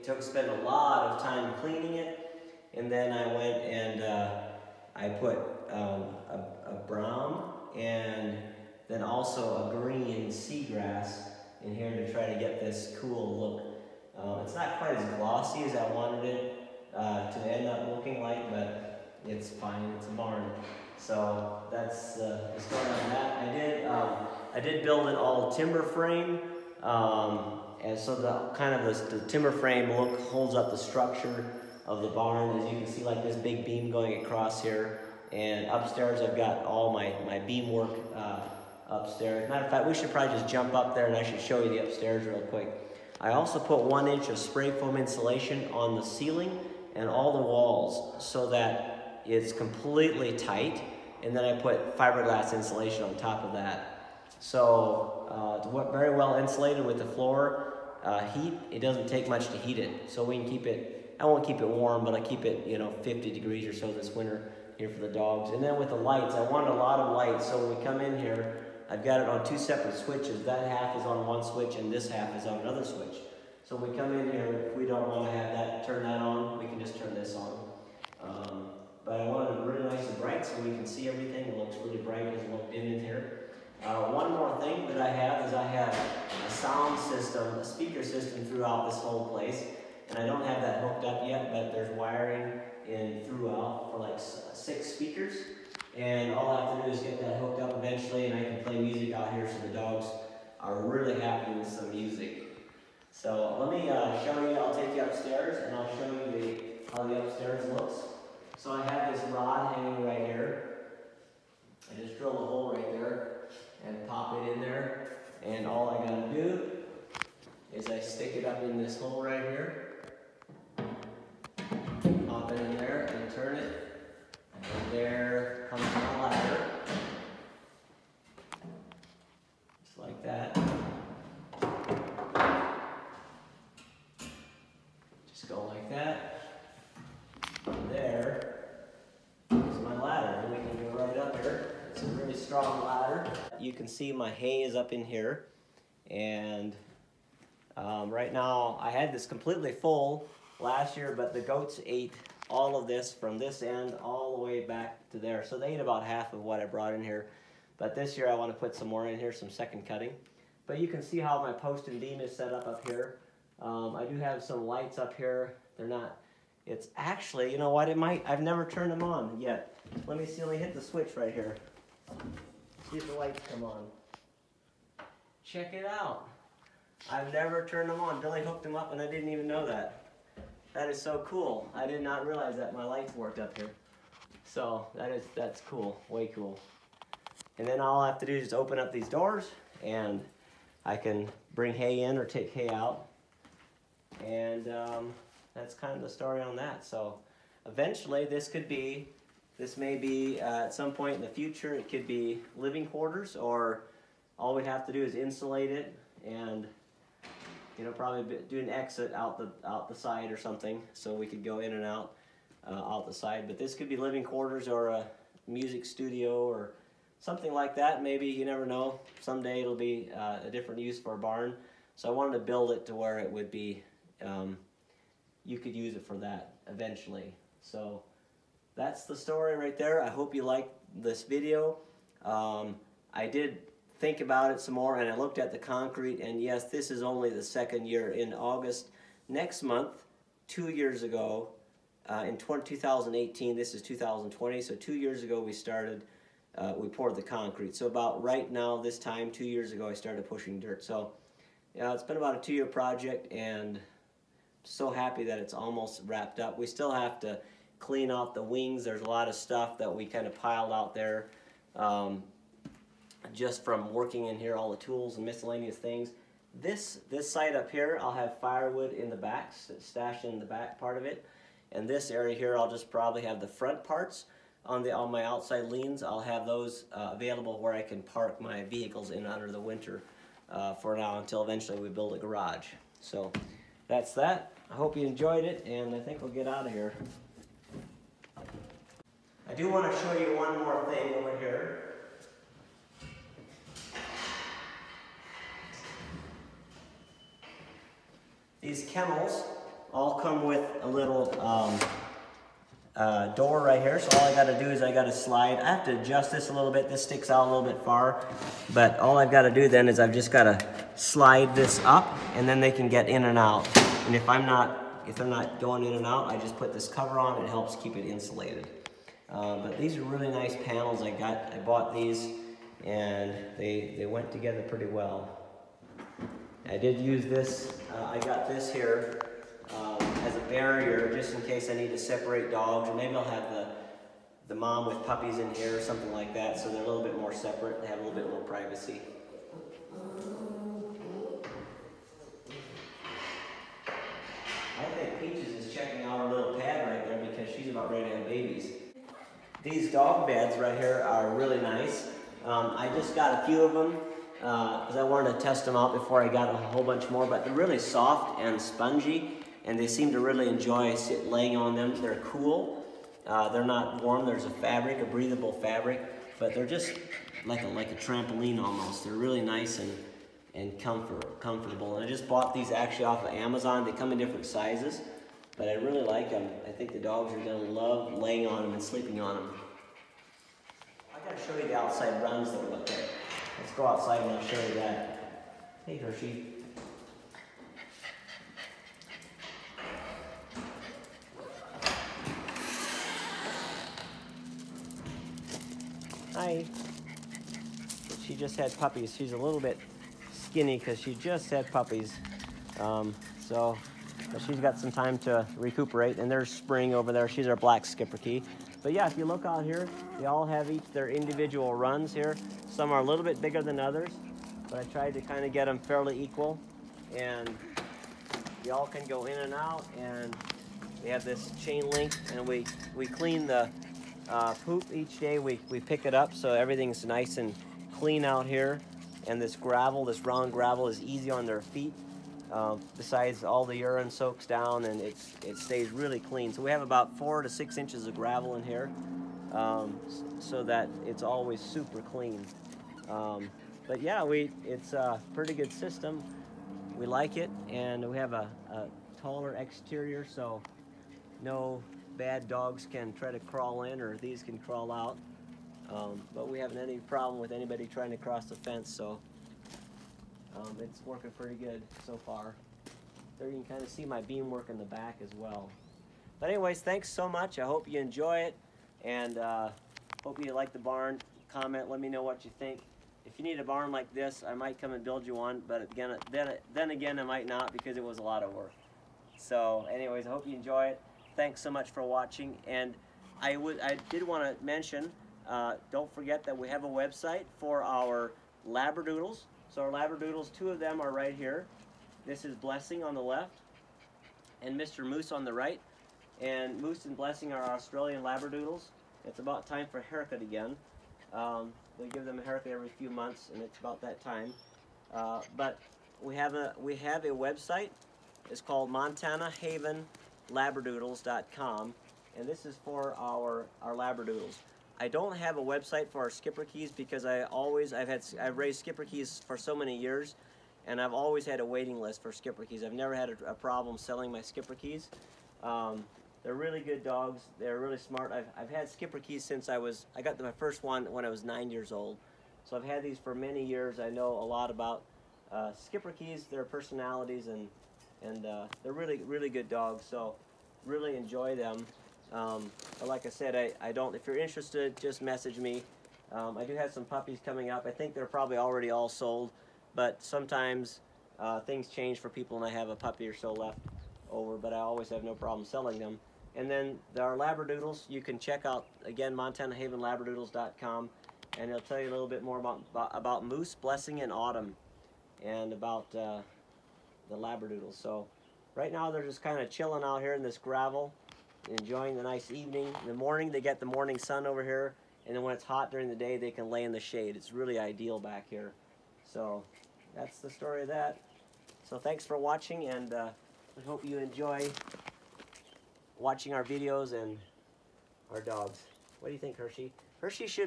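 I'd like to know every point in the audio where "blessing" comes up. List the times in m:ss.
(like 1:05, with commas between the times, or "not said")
8:12, 8:17, 9:23.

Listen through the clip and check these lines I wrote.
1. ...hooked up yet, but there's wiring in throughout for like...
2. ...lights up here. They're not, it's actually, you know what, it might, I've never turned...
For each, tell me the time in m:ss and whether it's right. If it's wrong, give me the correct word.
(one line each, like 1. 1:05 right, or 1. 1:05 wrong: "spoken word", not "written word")
1. 1:30 right
2. 2:44 right.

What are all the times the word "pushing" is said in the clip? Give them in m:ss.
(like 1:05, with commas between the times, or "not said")
4:10.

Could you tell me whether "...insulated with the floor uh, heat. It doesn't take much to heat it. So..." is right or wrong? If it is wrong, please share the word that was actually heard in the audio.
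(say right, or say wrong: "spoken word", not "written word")
right.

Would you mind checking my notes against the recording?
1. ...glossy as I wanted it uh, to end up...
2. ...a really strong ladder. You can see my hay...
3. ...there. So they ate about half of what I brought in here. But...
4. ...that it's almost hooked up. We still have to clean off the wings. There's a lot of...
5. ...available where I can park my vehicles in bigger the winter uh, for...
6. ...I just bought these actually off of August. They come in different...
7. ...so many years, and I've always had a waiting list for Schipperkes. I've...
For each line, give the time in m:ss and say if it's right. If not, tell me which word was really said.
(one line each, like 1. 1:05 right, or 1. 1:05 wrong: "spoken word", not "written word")
1. 0:15 right
2. 2:22 right
3. 2:35 right
4. 4:15 wrong: "wrapped", not "hooked"
5. 4:37 wrong: "under", not "bigger"
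6. 6:12 wrong: "Amazon", not "August"
7. 8:39 right.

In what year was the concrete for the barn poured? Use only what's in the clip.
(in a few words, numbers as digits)
2018.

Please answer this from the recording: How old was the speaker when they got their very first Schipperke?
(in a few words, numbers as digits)
9.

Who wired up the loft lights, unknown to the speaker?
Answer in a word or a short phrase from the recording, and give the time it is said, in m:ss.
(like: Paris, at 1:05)
Billy, at 2:58.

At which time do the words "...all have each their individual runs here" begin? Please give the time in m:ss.
6:50.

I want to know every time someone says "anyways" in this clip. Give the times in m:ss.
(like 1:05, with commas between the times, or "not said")
7:46, 7:59.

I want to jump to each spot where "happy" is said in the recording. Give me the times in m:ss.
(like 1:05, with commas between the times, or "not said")
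1:41, 4:14.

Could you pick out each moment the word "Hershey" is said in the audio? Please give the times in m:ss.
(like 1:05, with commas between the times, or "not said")
6:25, 9:49.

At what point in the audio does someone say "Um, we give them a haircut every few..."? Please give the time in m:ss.
8:21.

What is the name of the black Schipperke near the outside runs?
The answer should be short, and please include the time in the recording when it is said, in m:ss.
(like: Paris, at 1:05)
Spring, at 6:46.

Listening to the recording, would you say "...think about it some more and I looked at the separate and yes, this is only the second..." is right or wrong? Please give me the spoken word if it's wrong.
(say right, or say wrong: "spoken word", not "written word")
wrong: "concrete", not "separate".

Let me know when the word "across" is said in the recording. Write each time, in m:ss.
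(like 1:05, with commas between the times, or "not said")
0:34.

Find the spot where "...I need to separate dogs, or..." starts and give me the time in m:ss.
5:31.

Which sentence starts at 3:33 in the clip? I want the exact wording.
But this could be living quarters or a music studio or something like that.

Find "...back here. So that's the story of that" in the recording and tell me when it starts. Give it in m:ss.
9:38.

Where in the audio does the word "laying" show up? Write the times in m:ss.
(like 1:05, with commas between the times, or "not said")
6:01, 6:18.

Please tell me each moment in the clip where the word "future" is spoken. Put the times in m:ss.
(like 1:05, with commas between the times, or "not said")
3:21.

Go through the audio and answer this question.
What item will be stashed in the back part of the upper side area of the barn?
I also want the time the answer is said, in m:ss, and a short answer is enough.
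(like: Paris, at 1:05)
firewood, at 4:28.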